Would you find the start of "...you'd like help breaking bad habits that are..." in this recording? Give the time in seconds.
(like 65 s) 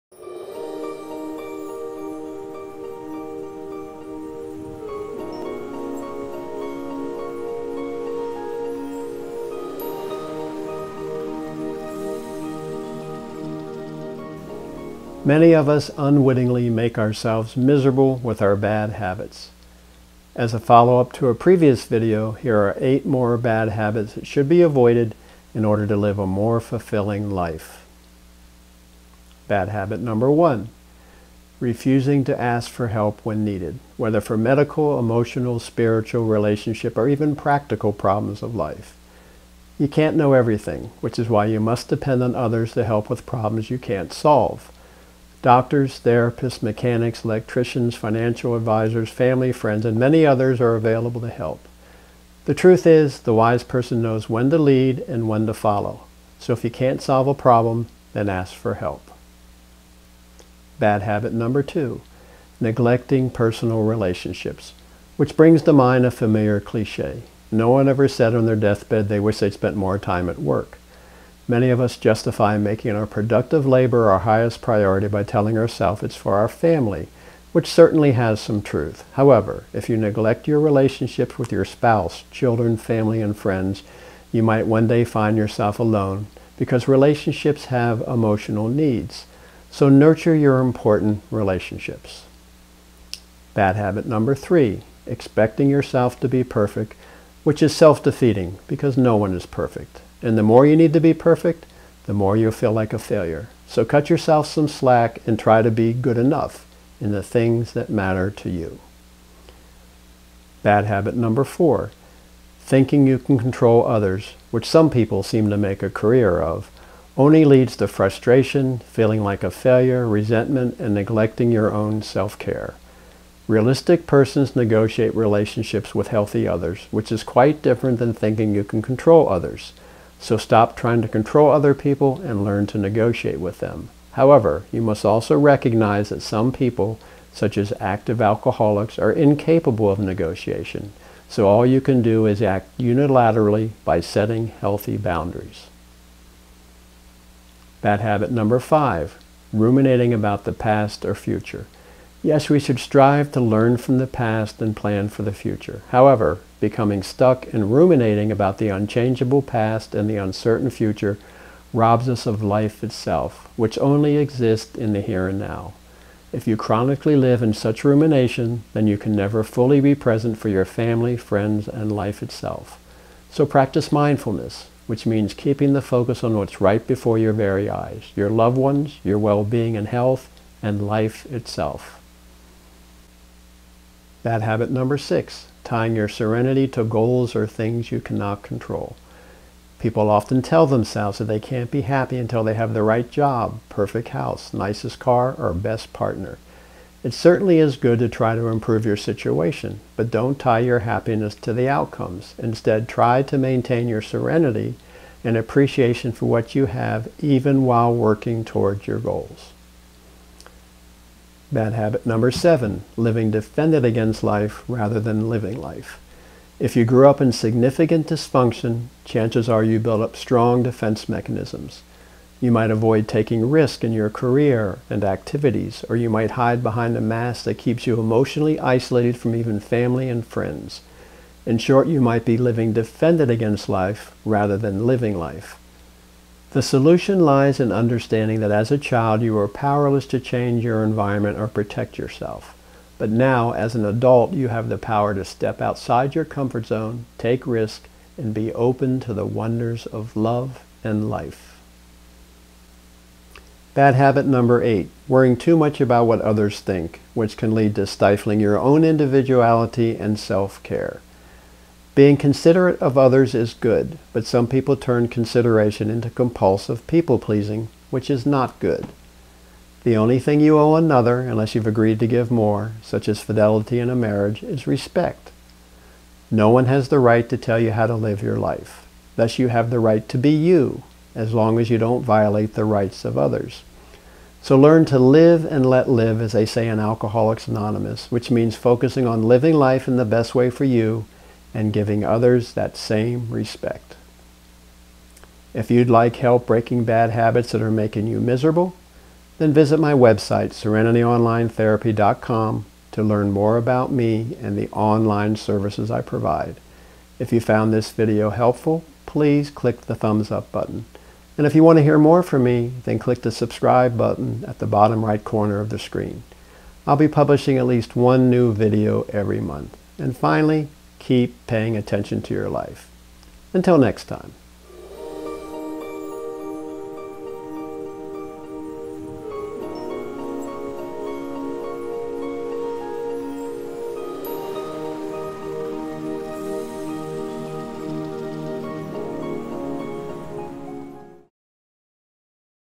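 295 s.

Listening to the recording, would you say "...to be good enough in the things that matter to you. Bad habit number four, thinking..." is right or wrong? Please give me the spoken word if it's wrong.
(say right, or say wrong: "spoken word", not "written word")
right.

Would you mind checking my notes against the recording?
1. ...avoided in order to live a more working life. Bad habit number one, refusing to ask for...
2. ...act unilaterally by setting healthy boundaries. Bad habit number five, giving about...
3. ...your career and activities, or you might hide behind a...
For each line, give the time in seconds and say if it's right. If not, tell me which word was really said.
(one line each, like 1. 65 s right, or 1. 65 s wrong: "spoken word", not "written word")
1. 24 s wrong: "fulfilling", not "working"
2. 142 s wrong: "ruminating", not "giving"
3. 223 s right.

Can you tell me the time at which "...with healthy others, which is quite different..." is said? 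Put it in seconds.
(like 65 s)
125 s.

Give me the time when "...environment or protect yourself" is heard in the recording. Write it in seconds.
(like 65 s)
240 s.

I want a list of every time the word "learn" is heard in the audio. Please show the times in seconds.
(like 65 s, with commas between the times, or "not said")
132 s, 153 s, 284 s, 303 s.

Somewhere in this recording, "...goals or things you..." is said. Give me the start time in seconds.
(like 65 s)
186 s.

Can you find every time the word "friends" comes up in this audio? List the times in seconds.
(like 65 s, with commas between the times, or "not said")
49 s, 83 s, 171 s, 230 s.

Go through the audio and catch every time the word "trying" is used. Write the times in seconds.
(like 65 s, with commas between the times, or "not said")
130 s.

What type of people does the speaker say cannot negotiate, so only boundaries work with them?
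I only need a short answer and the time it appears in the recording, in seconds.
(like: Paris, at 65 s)
active alcoholics, at 137 s.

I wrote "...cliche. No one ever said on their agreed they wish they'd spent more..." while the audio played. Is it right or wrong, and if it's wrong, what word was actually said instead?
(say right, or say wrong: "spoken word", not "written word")
wrong: "deathbed", not "agreed".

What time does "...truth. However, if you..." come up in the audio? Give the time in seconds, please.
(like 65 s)
78 s.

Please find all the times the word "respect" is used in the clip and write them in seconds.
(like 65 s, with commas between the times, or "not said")
274 s, 293 s.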